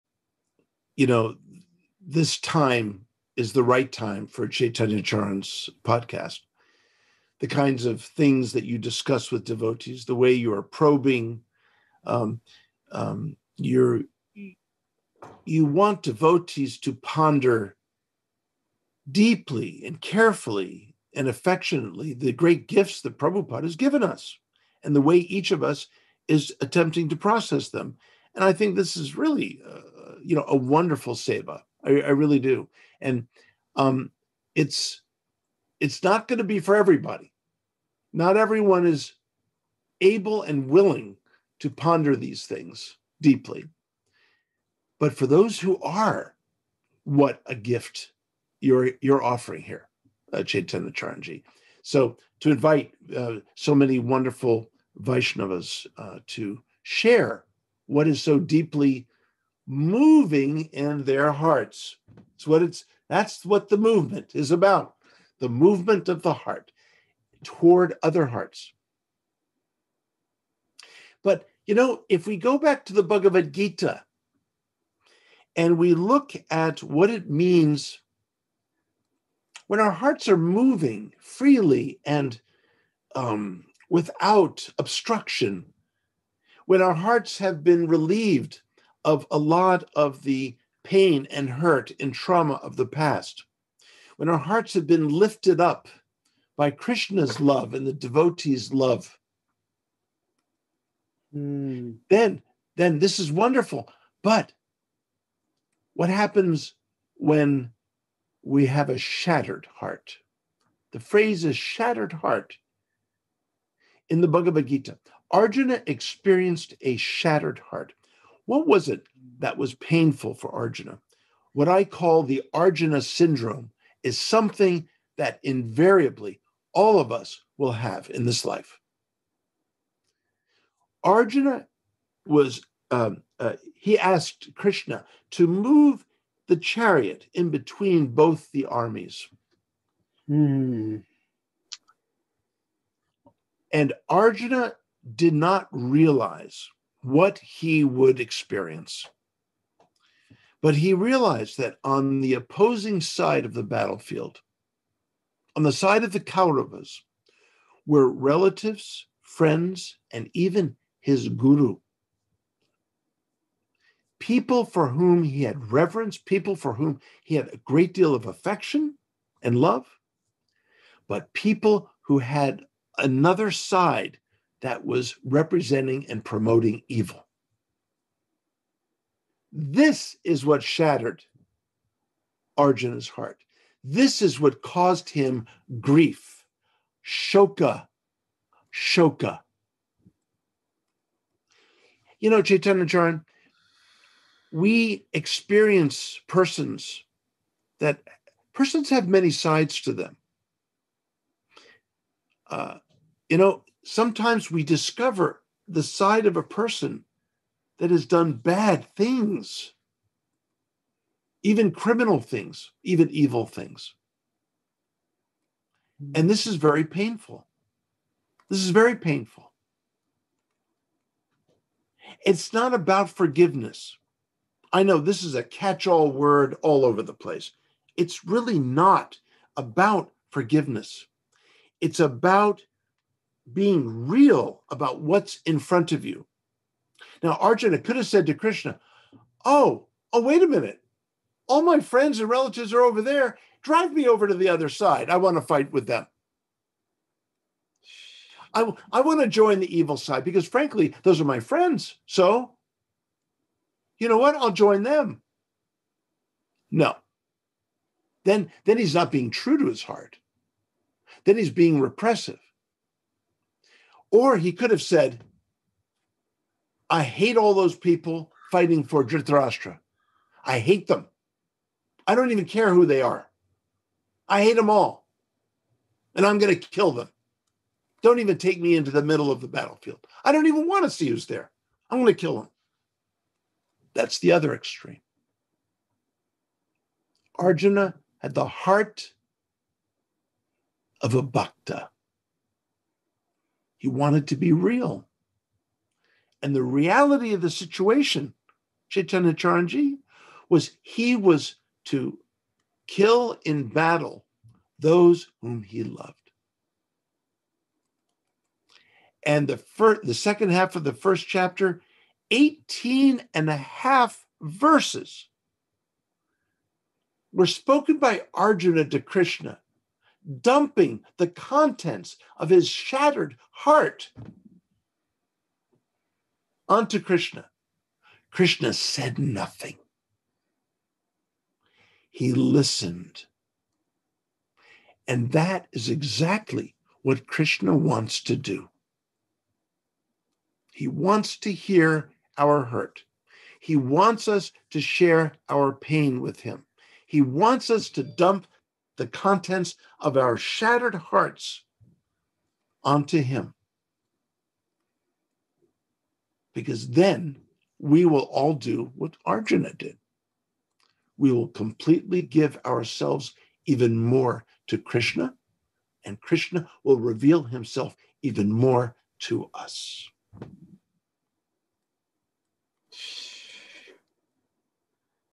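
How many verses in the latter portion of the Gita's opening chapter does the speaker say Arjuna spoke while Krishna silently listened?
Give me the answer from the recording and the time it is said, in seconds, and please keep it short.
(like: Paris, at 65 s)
18 and a half, at 312 s.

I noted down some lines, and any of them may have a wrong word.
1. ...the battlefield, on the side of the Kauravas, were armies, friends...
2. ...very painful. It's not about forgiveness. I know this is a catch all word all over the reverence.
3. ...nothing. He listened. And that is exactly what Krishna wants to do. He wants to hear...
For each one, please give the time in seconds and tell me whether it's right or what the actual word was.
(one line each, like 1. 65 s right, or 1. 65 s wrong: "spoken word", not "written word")
1. 153 s wrong: "relatives", not "armies"
2. 218 s wrong: "place", not "reverence"
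3. 329 s right.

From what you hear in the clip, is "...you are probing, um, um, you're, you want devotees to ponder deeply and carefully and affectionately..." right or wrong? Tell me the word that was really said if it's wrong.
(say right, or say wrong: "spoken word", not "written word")
right.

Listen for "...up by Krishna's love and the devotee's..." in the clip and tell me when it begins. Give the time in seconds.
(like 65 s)
95 s.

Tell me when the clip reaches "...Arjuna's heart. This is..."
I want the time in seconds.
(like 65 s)
182 s.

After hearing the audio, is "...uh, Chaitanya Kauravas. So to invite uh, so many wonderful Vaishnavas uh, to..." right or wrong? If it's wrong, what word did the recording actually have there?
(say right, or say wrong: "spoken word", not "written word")
wrong: "Charanji", not "Kauravas".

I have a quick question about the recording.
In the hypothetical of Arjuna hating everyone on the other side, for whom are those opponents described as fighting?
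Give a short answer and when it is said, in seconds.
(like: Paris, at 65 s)
Dhritarashtra, at 269 s.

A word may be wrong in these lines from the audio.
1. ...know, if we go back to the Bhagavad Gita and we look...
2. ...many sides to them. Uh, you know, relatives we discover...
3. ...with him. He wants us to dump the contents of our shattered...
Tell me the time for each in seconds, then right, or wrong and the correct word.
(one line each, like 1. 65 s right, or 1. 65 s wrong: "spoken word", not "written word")
1. 71 s right
2. 199 s wrong: "sometimes", not "relatives"
3. 346 s right.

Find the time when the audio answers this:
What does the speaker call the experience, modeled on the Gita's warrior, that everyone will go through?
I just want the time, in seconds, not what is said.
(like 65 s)
122 s.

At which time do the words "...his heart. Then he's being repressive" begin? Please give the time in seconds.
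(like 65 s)
259 s.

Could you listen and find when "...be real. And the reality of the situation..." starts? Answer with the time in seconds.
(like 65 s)
294 s.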